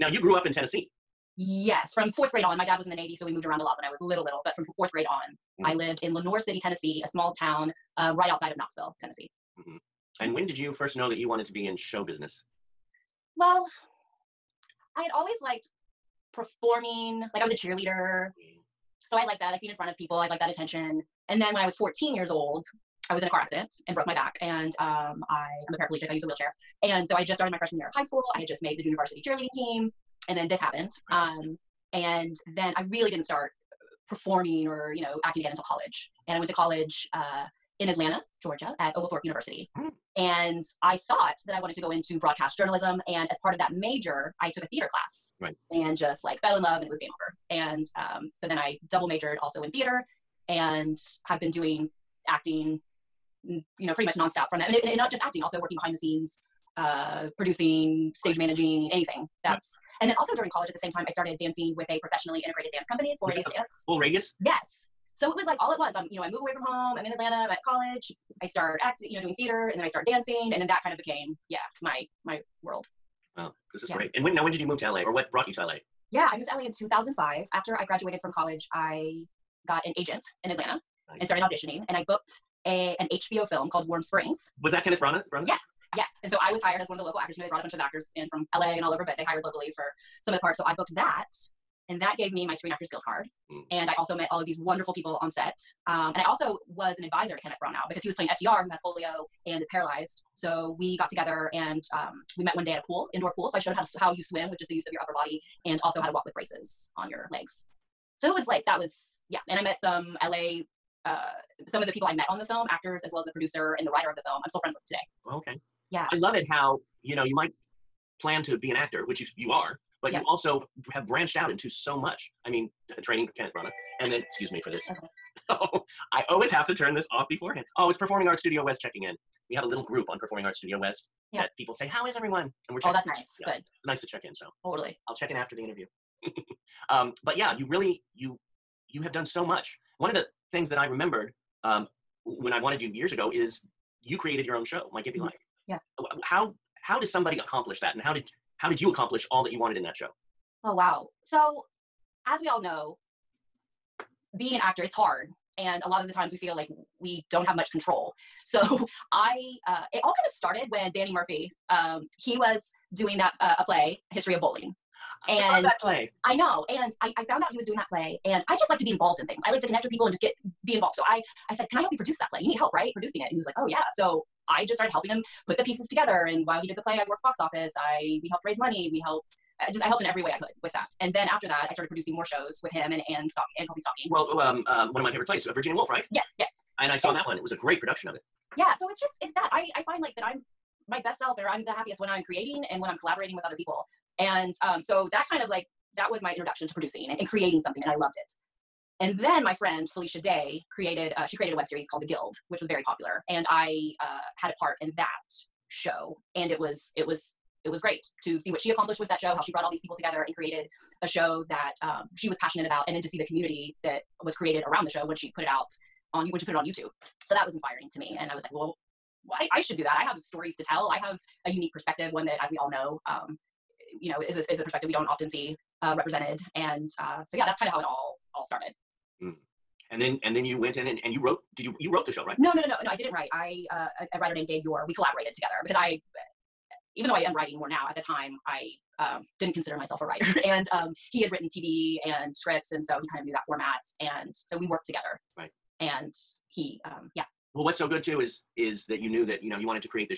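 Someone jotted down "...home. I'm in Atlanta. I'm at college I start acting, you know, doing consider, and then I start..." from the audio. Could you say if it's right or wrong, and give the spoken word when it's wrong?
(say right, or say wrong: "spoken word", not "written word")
wrong: "theater", not "consider".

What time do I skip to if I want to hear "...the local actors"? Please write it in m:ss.
1:26.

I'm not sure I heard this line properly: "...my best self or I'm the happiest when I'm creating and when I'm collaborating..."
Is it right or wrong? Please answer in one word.
right.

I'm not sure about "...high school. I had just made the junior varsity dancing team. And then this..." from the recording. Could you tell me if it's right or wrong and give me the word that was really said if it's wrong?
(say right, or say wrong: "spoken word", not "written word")
wrong: "cheerleading", not "dancing".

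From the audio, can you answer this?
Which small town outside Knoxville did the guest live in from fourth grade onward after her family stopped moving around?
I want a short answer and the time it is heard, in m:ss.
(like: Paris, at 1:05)
Lenoir City, at 0:06.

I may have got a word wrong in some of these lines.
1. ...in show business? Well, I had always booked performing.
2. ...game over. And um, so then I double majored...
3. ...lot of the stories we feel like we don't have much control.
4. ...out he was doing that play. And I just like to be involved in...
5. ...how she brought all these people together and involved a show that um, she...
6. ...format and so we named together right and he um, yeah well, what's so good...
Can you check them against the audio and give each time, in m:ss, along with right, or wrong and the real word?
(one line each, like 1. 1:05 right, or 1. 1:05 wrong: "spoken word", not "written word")
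1. 0:11 wrong: "liked", not "booked"
2. 0:47 right
3. 2:35 wrong: "times", not "stories"
4. 2:47 right
5. 3:29 wrong: "created", not "involved"
6. 4:03 wrong: "worked", not "named".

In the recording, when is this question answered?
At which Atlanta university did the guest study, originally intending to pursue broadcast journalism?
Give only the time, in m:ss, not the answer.
0:38.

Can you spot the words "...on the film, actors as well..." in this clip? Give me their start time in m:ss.
1:52.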